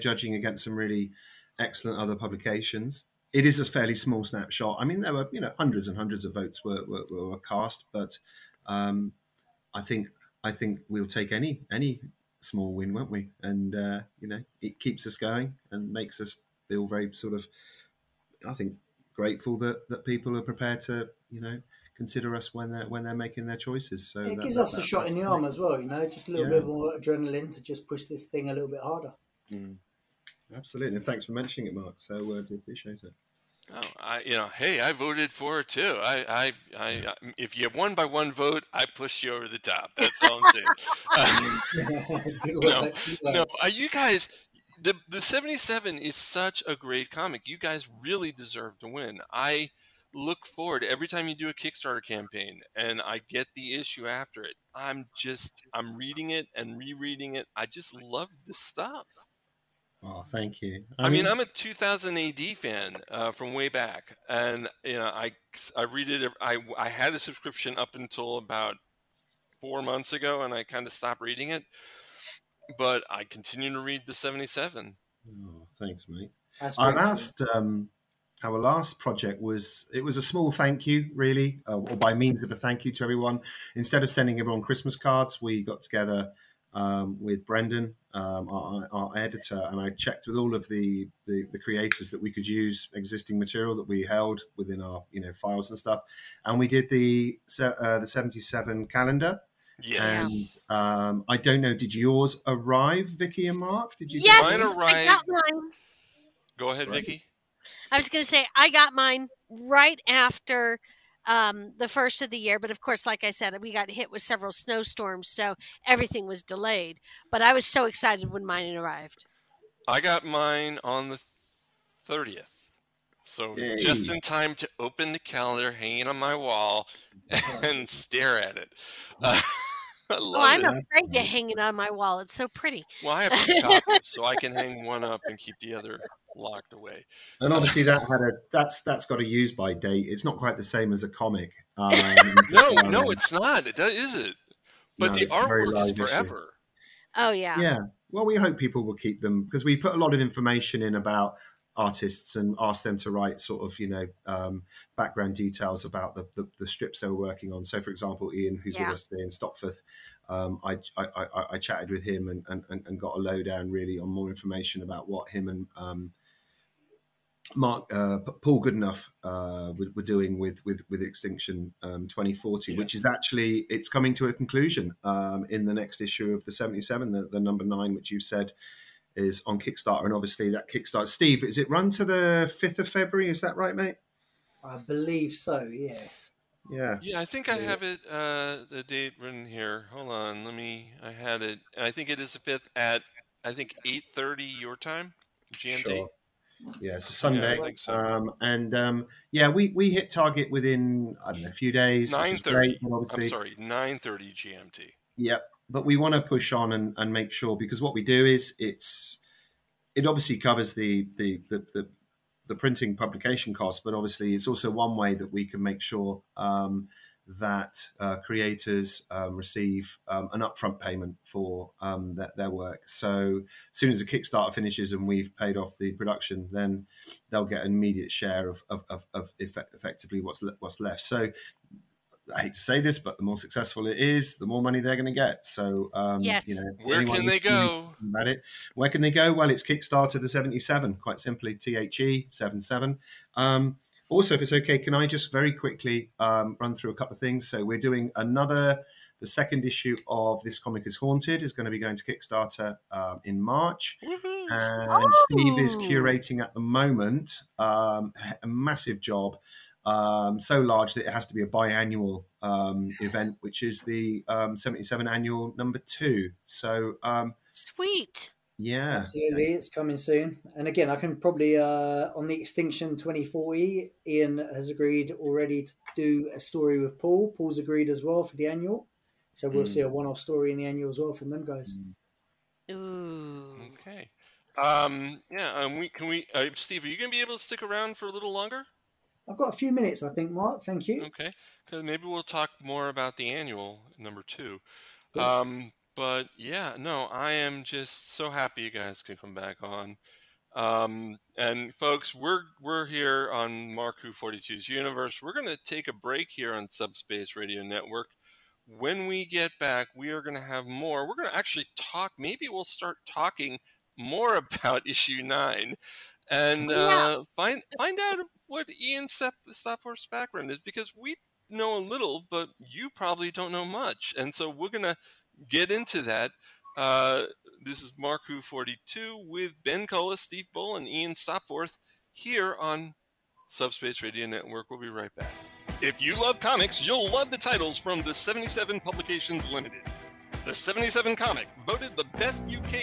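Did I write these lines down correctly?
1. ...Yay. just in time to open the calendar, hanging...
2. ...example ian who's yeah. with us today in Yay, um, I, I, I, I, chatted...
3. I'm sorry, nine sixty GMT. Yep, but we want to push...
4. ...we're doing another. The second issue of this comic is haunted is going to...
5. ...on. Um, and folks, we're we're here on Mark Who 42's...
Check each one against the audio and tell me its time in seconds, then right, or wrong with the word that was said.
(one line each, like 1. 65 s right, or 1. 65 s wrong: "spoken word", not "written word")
1. 123 s right
2. 157 s wrong: "Stopforth", not "Yay"
3. 203 s wrong: "thirty", not "sixty"
4. 247 s right
5. 299 s right.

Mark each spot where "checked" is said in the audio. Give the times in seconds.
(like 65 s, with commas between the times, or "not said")
89 s.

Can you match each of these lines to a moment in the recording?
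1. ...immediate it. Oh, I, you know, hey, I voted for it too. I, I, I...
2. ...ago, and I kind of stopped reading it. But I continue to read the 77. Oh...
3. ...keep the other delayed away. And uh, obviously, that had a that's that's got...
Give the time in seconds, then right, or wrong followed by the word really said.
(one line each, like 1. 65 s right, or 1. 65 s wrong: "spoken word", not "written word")
1. 32 s wrong: "appreciate", not "immediate"
2. 70 s right
3. 135 s wrong: "locked", not "delayed".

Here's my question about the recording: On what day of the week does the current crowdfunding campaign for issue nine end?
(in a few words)
Sunday.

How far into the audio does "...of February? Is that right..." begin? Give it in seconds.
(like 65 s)
182 s.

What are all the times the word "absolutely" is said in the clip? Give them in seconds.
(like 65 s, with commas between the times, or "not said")
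30 s, 268 s.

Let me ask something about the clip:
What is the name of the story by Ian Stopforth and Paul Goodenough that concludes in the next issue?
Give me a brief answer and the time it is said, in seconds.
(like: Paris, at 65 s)
Extinction 2040, at 171 s.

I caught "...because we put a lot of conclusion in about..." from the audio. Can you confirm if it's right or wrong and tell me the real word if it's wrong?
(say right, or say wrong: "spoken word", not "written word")
wrong: "information", not "conclusion".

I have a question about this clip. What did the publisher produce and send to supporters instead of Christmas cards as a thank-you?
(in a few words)
The 77 calendar.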